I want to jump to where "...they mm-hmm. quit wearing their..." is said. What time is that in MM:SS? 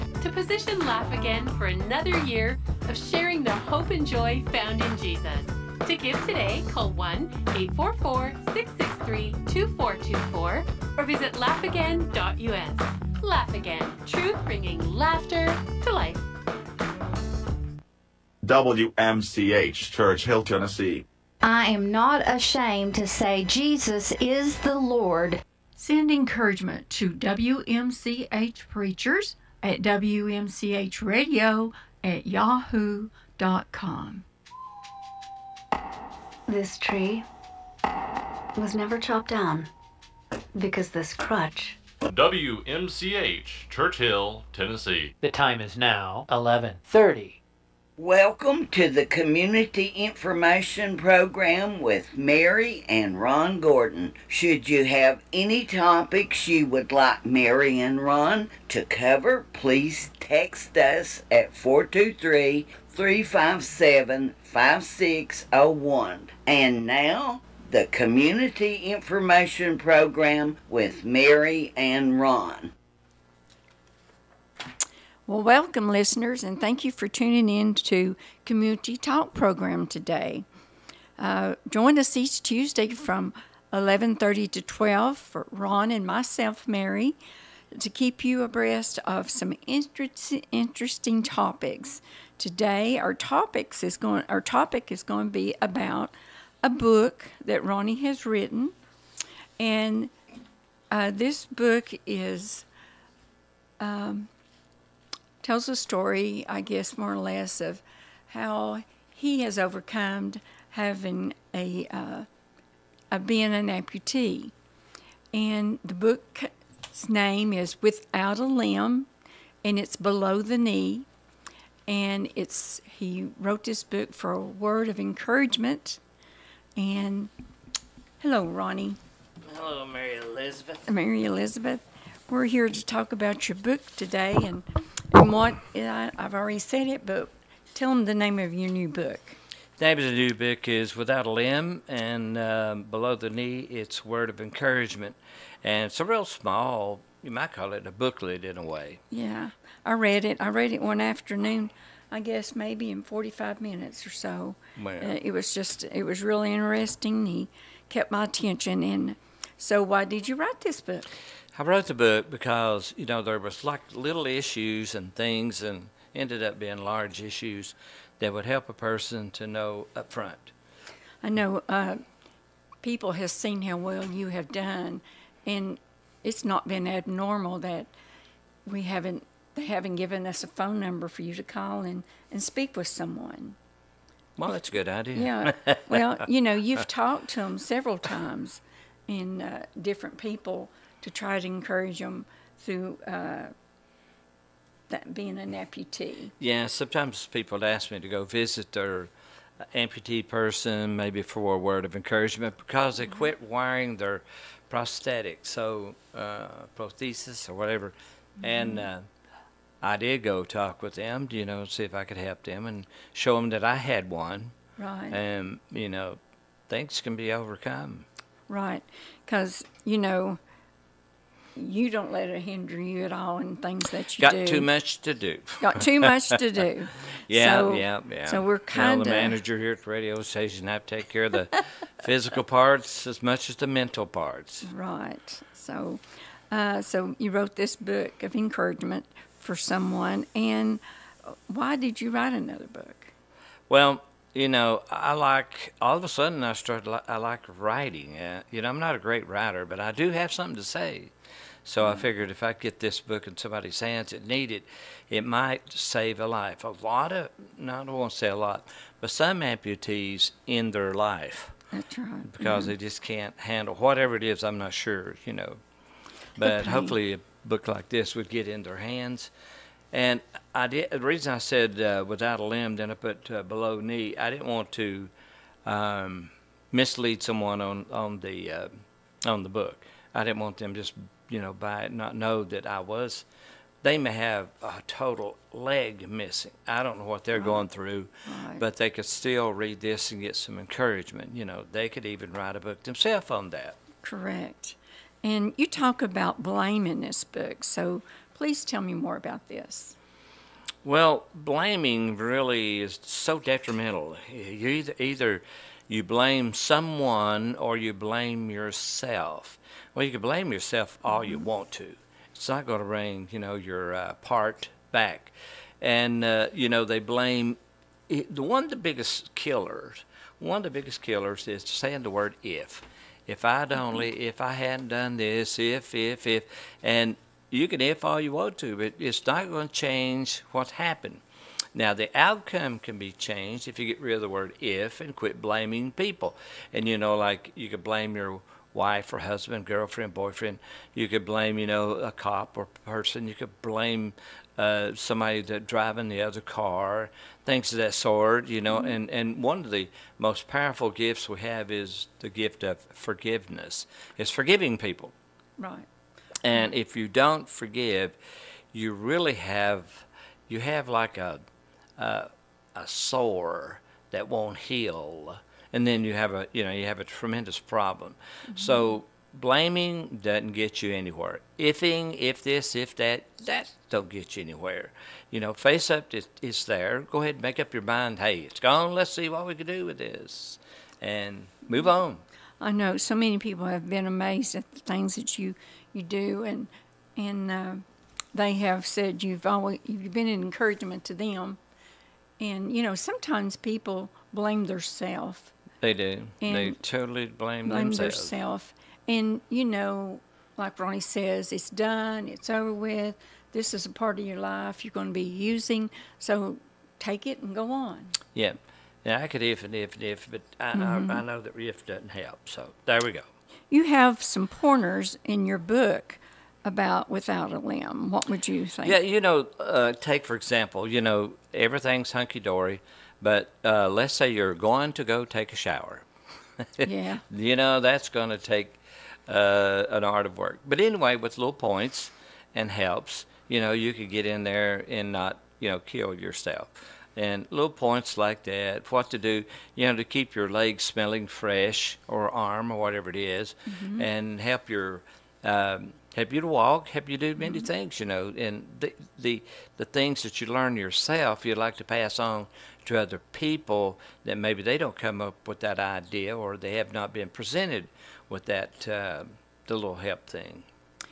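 03:22.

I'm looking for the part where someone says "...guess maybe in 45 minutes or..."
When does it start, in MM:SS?
02:32.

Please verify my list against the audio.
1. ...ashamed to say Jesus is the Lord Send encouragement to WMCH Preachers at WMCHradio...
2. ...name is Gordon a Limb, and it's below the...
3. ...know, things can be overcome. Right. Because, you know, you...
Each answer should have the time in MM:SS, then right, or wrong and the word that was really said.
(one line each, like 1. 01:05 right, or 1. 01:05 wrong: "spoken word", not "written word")
1. 00:22 right
2. 01:57 wrong: "Without", not "Gordon"
3. 03:35 right.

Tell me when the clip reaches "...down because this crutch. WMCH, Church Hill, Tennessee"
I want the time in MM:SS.
00:39.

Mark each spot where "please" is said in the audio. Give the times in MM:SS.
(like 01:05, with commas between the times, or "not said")
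00:59, 04:58.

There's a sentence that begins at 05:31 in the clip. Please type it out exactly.
Now, the outcome can be changed if you get rid of the word if and quit blaming people.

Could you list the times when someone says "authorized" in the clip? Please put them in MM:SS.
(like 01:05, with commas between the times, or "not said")
not said.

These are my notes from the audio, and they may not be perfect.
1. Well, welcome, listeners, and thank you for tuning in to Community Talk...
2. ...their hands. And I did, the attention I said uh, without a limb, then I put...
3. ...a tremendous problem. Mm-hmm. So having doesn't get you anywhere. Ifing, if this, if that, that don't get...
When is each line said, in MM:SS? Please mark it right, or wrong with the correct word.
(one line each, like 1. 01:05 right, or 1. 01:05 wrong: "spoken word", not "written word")
1. 01:15 right
2. 04:28 wrong: "reason", not "attention"
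3. 06:06 wrong: "blaming", not "having".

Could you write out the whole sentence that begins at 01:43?
Um, tells a story, I guess, more or less, of how he has overcome having a, uh, a being an amputee.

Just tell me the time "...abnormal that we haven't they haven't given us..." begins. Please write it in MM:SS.
02:56.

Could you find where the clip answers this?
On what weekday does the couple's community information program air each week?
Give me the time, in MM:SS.
01:22.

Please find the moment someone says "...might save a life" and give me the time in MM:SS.
04:15.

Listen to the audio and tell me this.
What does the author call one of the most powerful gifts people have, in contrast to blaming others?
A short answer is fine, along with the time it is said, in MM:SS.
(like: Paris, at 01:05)
forgiveness, at 05:52.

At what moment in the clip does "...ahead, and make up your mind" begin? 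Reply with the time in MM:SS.
06:17.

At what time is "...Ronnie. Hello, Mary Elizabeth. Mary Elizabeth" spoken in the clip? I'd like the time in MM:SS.
02:08.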